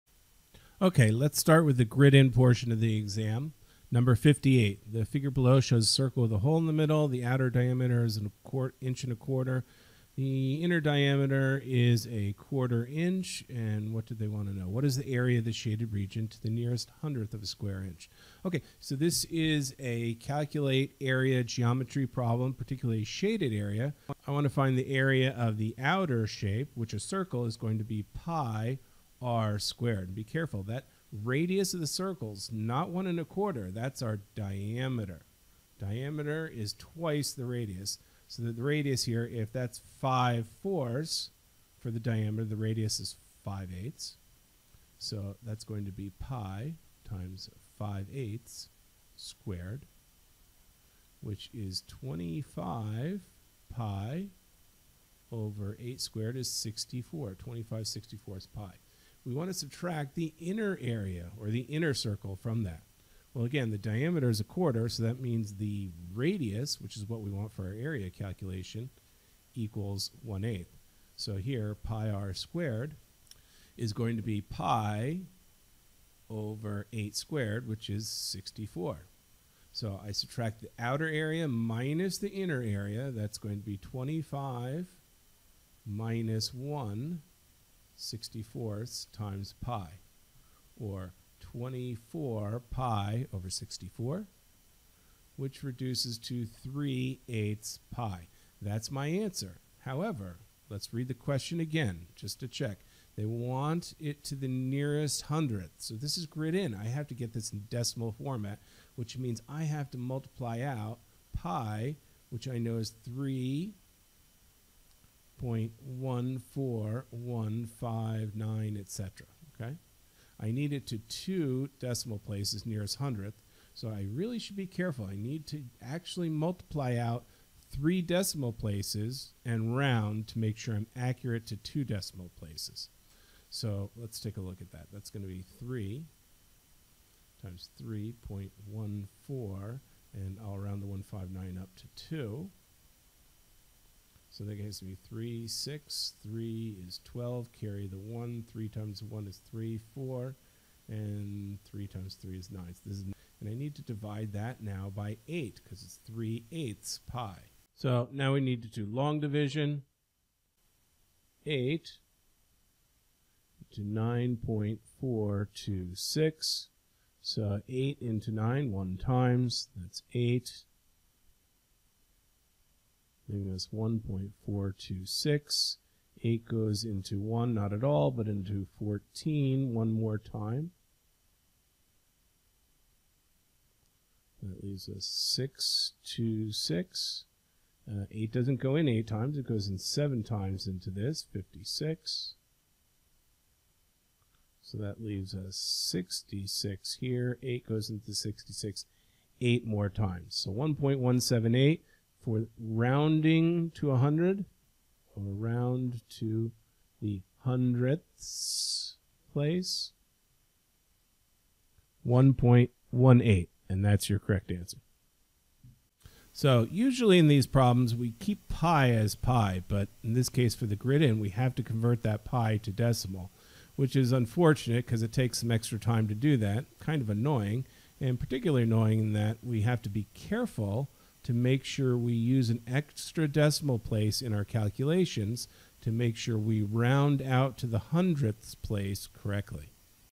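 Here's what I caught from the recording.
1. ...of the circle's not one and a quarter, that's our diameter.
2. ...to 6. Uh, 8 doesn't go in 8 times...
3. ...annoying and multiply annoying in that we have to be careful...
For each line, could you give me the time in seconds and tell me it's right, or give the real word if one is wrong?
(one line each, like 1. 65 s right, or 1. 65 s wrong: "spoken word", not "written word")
1. 31 s right
2. 186 s right
3. 227 s wrong: "particularly", not "multiply".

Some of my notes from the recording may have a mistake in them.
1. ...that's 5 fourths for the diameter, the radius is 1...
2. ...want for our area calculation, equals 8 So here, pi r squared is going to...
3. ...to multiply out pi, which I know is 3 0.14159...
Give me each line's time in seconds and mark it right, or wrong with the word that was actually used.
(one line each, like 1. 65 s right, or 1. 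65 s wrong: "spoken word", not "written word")
1. 39 s wrong: "5", not "1"
2. 67 s wrong: "1", not "8"
3. 109 s right.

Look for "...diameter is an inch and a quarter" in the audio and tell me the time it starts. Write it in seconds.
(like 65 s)
7 s.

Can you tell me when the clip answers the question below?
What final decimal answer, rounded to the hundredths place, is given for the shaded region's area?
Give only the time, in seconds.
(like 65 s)
212 s.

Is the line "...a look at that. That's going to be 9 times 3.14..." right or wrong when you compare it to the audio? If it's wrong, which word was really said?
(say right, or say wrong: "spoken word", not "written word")
wrong: "3", not "9".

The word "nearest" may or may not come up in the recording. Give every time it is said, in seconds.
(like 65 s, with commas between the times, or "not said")
16 s, 104 s, 122 s.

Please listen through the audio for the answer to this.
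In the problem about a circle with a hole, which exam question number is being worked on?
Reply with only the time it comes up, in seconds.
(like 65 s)
3 s.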